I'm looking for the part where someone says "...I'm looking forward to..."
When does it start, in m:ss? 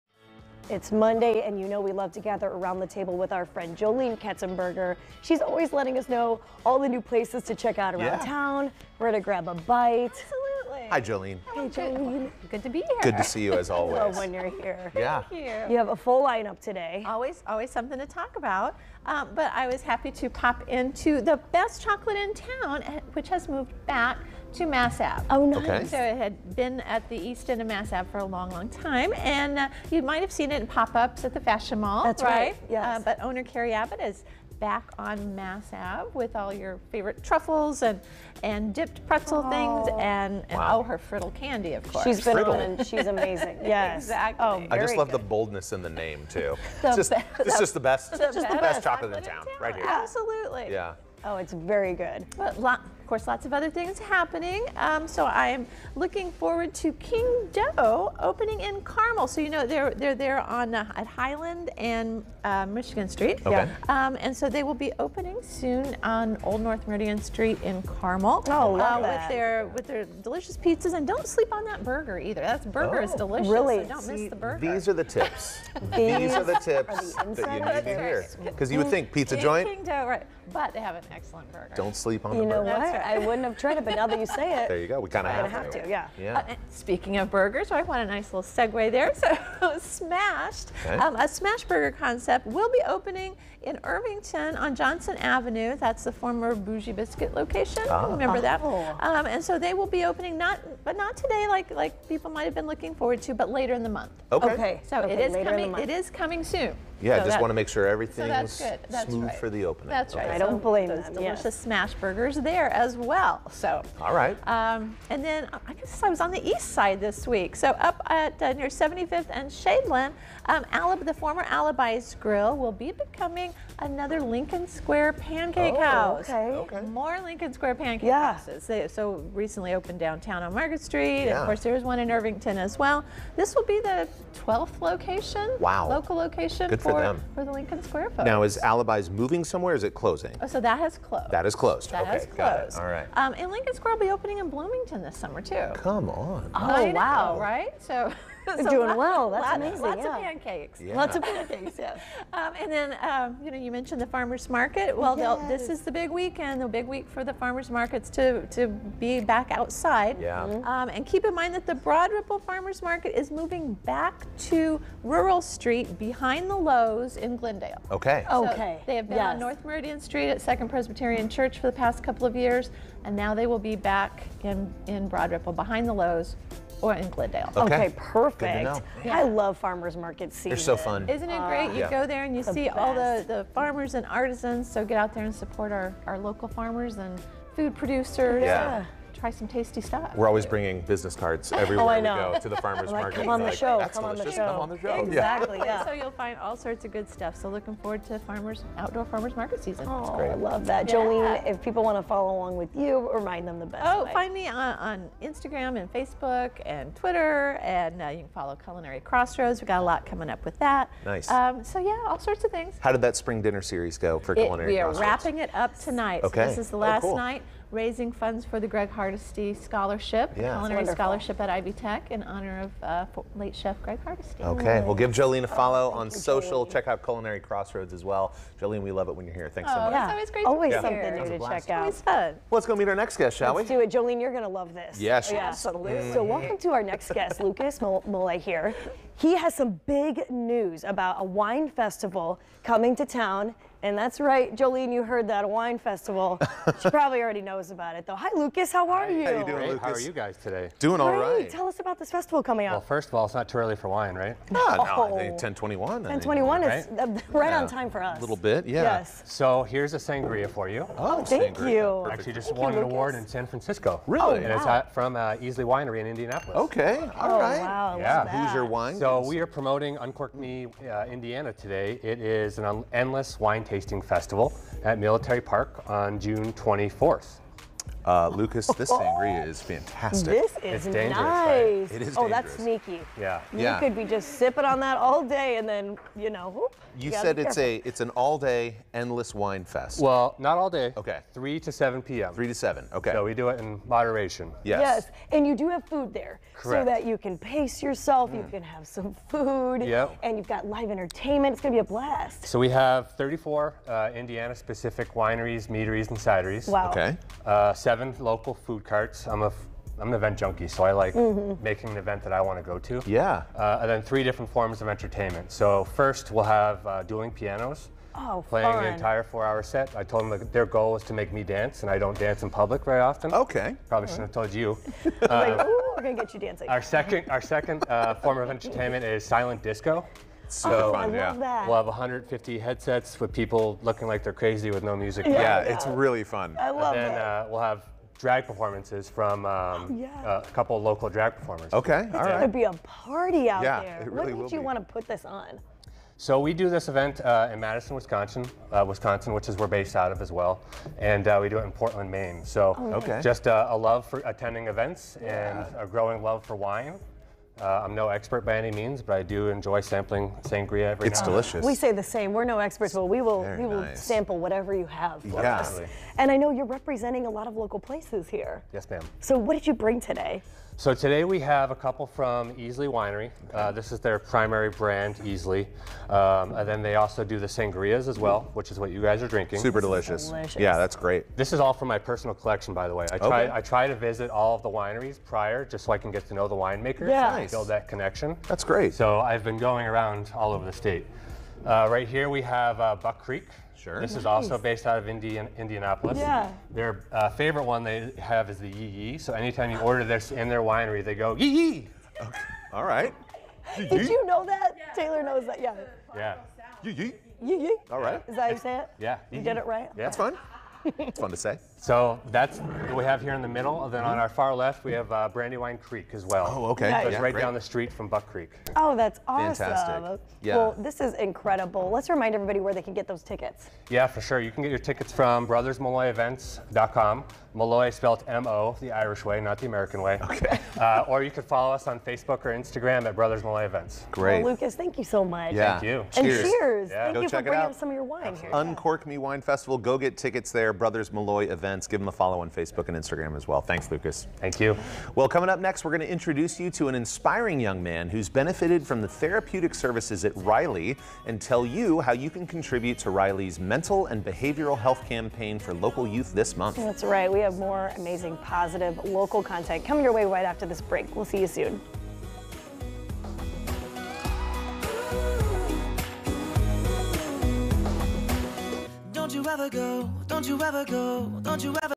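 0:55.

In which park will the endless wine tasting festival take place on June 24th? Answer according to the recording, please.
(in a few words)
Military Park.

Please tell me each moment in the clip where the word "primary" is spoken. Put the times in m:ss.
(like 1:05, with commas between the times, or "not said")
6:14.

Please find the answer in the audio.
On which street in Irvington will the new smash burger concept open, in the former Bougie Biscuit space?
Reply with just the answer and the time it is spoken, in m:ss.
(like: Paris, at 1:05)
Johnson Avenue, at 1:34.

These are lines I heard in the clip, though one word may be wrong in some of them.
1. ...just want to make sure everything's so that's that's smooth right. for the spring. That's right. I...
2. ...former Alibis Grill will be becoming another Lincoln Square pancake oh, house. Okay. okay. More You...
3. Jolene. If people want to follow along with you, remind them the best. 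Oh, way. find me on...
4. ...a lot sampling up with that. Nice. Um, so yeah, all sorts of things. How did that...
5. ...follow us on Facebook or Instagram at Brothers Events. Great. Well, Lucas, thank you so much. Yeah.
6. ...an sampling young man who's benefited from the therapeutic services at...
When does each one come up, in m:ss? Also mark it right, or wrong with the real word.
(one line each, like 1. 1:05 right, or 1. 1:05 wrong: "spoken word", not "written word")
1. 1:47 wrong: "opening", not "spring"
2. 2:01 wrong: "Lincoln", not "You"
3. 3:20 right
4. 3:29 wrong: "coming", not "sampling"
5. 7:11 right
6. 7:26 wrong: "inspiring", not "sampling".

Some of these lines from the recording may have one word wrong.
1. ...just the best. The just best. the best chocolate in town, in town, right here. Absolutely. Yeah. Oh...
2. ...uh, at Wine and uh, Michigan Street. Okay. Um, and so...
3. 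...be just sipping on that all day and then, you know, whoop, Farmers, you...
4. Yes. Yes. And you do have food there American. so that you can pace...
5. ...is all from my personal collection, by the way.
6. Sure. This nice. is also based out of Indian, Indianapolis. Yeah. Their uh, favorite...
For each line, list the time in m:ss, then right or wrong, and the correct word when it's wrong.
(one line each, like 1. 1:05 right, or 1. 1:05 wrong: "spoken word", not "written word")
1. 0:47 right
2. 1:00 wrong: "Highland", not "Wine"
3. 4:43 wrong: "You", not "Farmers"
4. 4:54 wrong: "Correct", not "American"
5. 6:21 right
6. 6:33 right.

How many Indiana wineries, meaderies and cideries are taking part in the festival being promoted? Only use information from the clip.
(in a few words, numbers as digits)
34.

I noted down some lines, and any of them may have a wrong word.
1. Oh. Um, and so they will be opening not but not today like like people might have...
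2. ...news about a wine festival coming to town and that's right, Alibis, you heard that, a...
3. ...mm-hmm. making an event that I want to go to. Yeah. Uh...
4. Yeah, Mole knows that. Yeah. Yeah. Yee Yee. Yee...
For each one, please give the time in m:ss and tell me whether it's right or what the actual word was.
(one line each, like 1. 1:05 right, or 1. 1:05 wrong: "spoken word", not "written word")
1. 1:38 right
2. 4:00 wrong: "Jolene", not "Alibis"
3. 5:11 right
4. 6:44 wrong: "Taylor", not "Mole".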